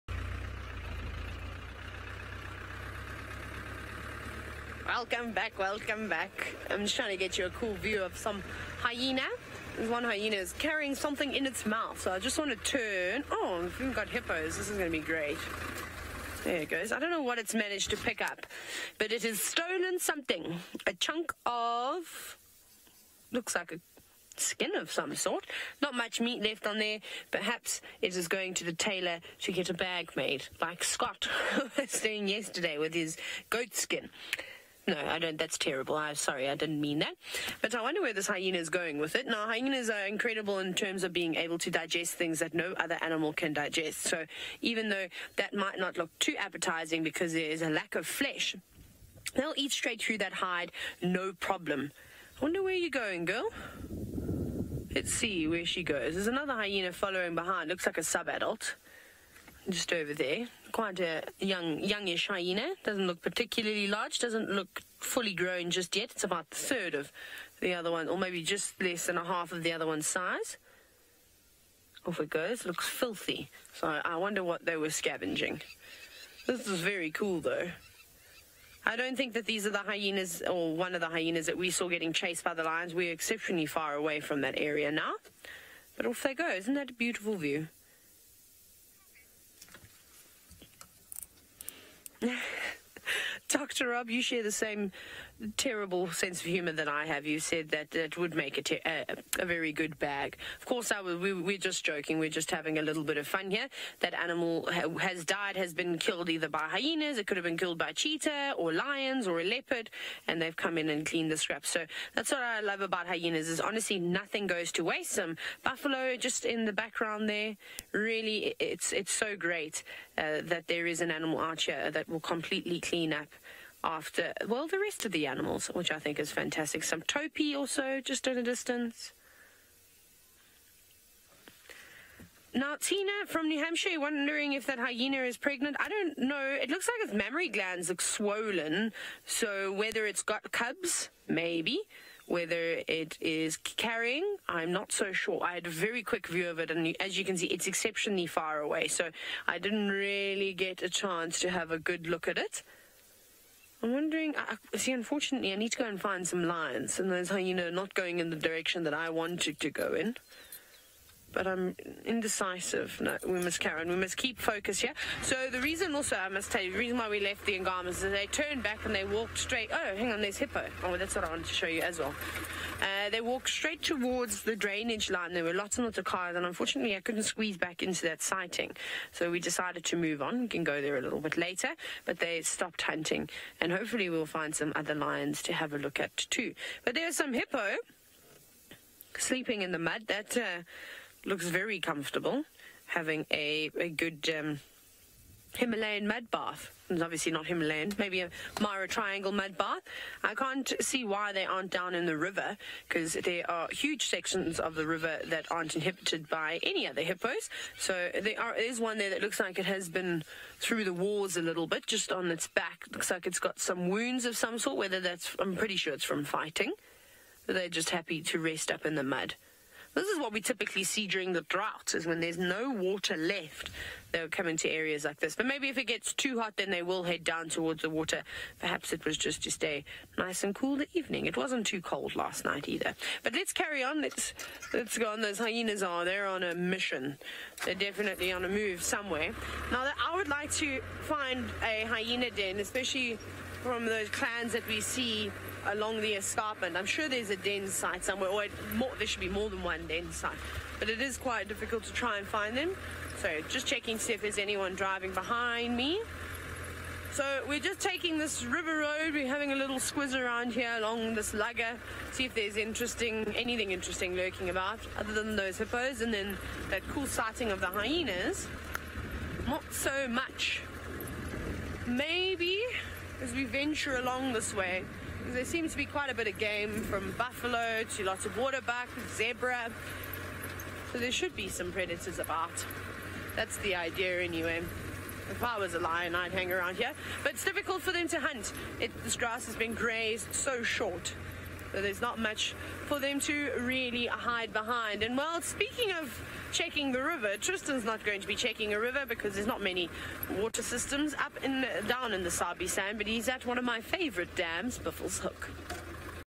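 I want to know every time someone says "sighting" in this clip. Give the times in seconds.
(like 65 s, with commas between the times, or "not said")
178 s, 267 s.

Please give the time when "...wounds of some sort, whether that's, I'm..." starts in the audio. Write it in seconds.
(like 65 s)
213 s.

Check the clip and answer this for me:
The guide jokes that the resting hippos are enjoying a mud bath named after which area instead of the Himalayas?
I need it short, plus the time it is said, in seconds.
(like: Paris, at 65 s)
Mara Triangle, at 198 s.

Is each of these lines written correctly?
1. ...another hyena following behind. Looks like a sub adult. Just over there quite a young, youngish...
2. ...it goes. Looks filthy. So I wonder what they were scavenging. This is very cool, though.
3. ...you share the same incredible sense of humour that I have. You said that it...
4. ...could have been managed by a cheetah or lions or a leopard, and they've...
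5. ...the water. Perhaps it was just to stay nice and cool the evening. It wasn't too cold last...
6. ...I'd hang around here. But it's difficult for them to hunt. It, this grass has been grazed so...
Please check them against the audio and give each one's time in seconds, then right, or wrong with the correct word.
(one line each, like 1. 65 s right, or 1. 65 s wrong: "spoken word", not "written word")
1. 56 s right
2. 72 s right
3. 94 s wrong: "terrible", not "incredible"
4. 107 s wrong: "killed", not "managed"
5. 227 s right
6. 286 s right.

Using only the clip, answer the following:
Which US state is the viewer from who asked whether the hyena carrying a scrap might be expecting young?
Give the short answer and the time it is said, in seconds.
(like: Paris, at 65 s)
New Hampshire, at 133 s.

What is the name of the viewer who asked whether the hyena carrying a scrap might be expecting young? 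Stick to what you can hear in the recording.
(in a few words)
Tina.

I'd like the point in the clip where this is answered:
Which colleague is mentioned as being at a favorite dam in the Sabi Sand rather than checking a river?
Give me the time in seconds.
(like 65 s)
297 s.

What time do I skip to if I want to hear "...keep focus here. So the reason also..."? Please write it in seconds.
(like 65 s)
164 s.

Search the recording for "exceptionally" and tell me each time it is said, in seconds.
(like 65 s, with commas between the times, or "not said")
83 s, 147 s.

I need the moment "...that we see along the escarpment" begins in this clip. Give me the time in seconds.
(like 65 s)
244 s.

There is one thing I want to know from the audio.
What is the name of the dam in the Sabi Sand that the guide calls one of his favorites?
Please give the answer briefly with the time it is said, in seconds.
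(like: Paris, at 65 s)
Buffelshoek, at 304 s.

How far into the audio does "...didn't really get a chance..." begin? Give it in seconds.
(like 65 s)
149 s.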